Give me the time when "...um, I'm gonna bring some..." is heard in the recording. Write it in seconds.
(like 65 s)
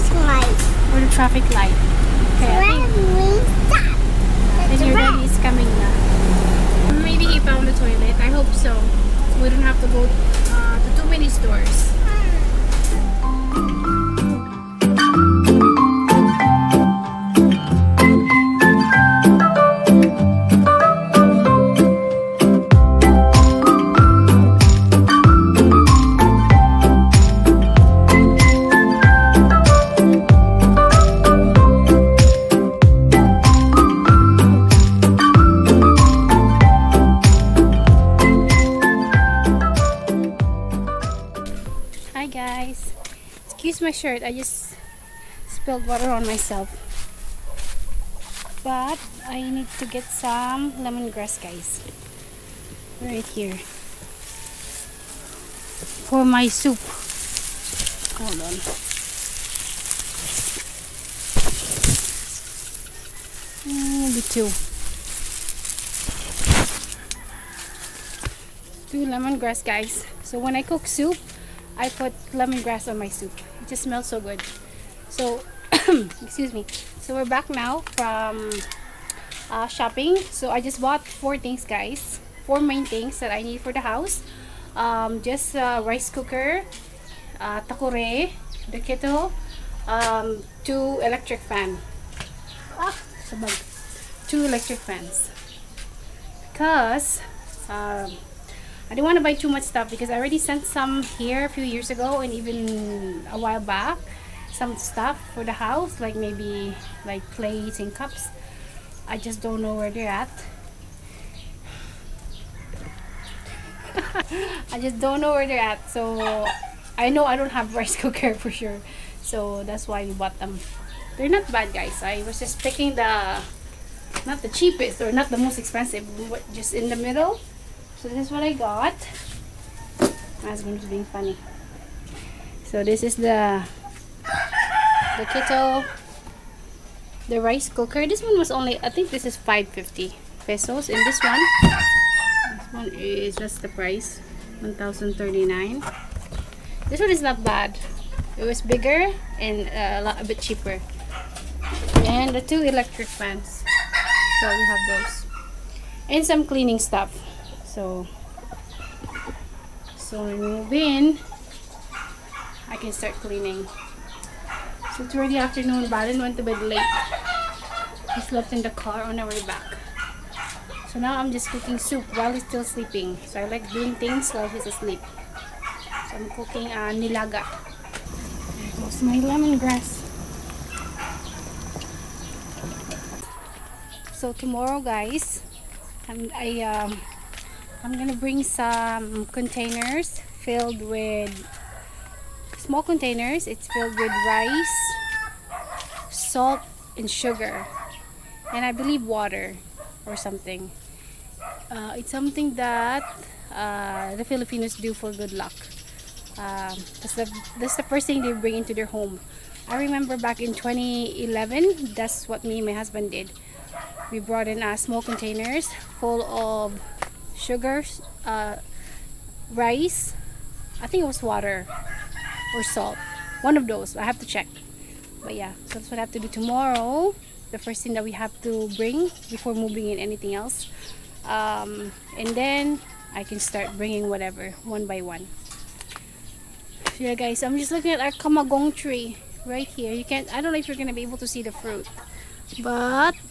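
186 s.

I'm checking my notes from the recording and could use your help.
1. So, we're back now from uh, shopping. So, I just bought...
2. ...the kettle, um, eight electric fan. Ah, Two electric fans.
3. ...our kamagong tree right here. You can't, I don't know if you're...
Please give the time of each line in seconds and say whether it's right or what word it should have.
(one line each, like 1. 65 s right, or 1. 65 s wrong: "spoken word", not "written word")
1. 76 s right
2. 88 s wrong: "two", not "eight"
3. 237 s right.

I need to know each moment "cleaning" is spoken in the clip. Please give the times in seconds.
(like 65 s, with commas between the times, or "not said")
156 s, 163 s.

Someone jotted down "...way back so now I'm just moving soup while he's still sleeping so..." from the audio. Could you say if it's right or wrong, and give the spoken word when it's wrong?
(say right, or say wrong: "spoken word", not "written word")
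wrong: "cooking", not "moving".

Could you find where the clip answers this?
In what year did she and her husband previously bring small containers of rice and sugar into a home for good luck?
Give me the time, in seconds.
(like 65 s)
210 s.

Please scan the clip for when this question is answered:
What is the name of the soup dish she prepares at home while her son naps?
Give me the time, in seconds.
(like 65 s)
176 s.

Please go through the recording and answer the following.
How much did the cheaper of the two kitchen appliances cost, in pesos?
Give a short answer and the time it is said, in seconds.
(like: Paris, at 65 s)
550 pesos, at 139 s.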